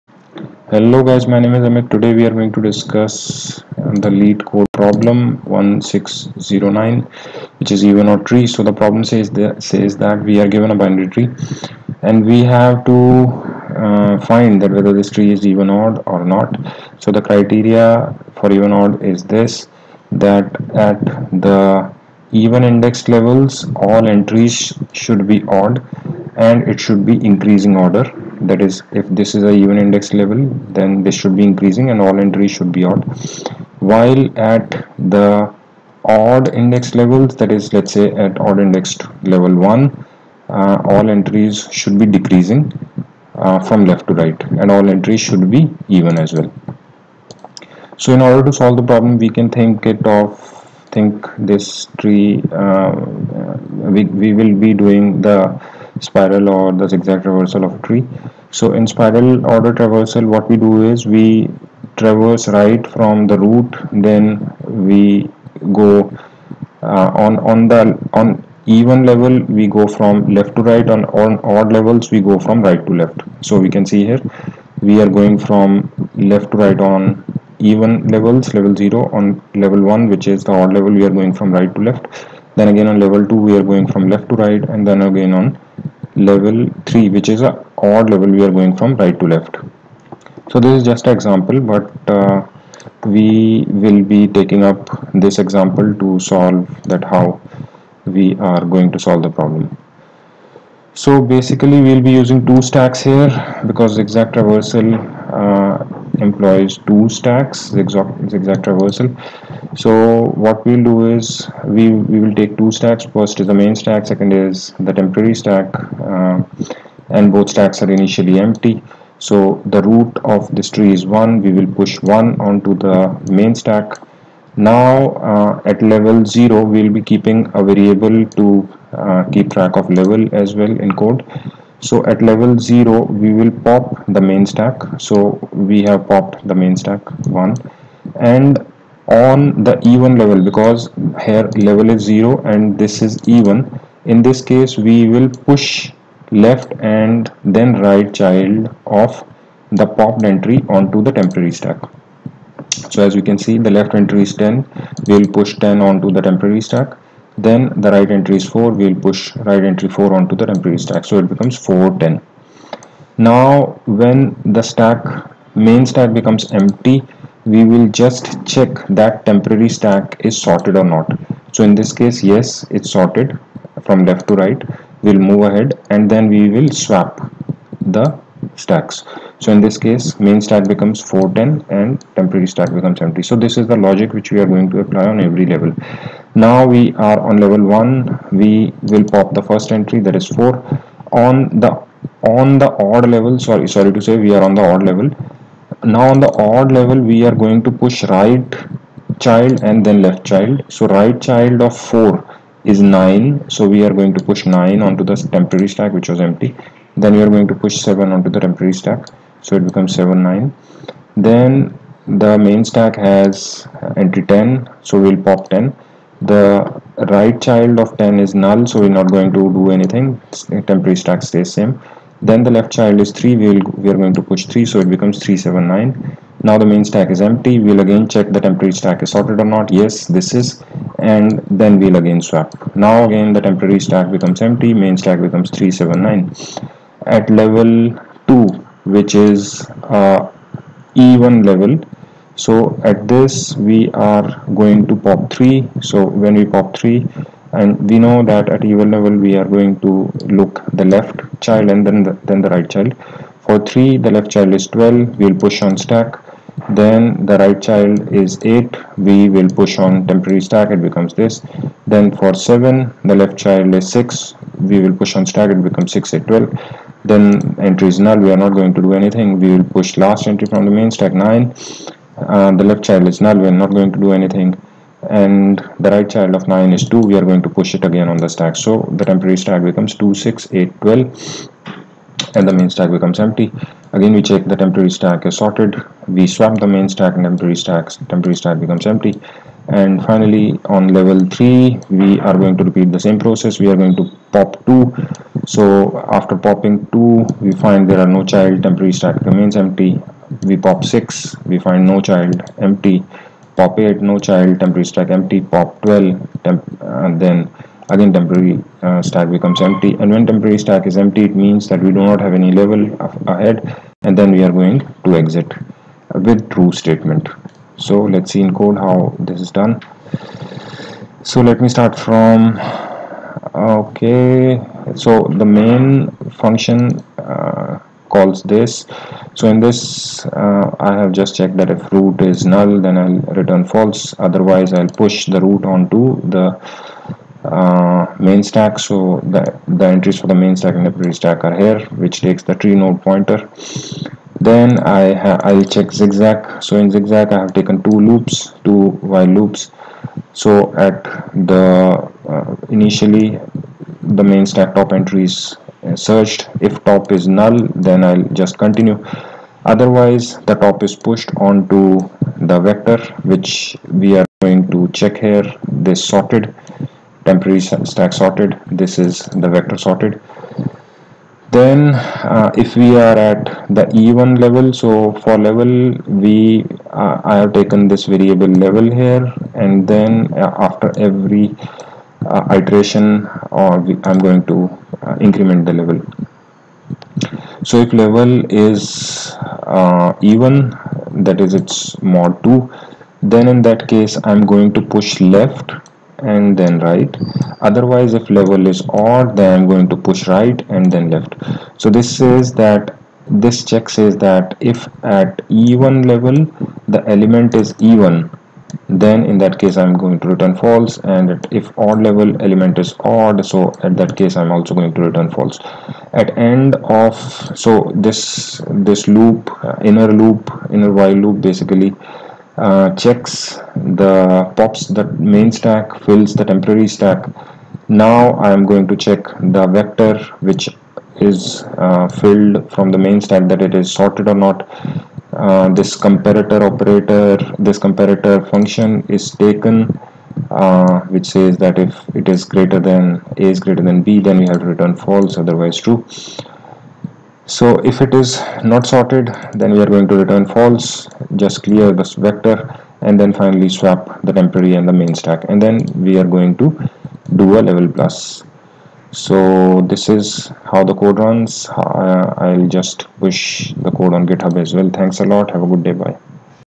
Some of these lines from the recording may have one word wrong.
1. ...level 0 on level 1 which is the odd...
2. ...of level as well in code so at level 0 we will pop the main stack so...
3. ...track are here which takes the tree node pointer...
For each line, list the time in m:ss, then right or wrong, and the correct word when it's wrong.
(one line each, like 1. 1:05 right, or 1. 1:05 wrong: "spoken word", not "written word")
1. 1:18 right
2. 2:09 right
3. 5:41 wrong: "stack", not "track".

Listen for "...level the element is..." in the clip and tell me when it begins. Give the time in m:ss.
6:46.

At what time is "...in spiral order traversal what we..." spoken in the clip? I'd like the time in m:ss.
0:58.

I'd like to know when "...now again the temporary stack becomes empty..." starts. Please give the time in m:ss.
3:52.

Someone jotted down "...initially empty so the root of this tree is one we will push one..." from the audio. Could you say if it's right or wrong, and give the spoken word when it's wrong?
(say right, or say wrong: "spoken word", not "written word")
right.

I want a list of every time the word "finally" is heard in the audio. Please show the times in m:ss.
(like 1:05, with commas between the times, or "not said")
4:50, 7:33.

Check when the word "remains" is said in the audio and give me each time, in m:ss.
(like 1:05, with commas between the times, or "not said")
4:59.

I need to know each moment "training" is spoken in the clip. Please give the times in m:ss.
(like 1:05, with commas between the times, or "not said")
not said.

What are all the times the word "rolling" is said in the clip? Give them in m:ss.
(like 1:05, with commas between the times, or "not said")
not said.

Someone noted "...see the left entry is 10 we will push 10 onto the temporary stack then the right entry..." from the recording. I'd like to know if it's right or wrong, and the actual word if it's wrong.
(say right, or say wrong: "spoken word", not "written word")
right.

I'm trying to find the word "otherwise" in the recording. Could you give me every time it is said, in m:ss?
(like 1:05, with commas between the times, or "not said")
5:34, 5:59, 6:37, 7:25.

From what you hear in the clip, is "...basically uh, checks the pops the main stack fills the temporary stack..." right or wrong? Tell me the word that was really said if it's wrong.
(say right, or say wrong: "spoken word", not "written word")
right.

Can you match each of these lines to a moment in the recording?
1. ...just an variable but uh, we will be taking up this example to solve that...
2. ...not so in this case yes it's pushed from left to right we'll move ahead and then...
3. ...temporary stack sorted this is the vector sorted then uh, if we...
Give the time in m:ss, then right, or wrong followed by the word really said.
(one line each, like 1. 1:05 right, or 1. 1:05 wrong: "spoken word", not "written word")
1. 1:30 wrong: "example", not "variable"
2. 2:50 wrong: "sorted", not "pushed"
3. 6:07 right.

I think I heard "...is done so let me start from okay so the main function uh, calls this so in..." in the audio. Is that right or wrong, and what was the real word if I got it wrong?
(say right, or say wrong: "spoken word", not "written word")
right.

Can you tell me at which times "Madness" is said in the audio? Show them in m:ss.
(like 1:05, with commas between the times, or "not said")
not said.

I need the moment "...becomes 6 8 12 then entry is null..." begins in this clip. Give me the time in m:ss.
4:25.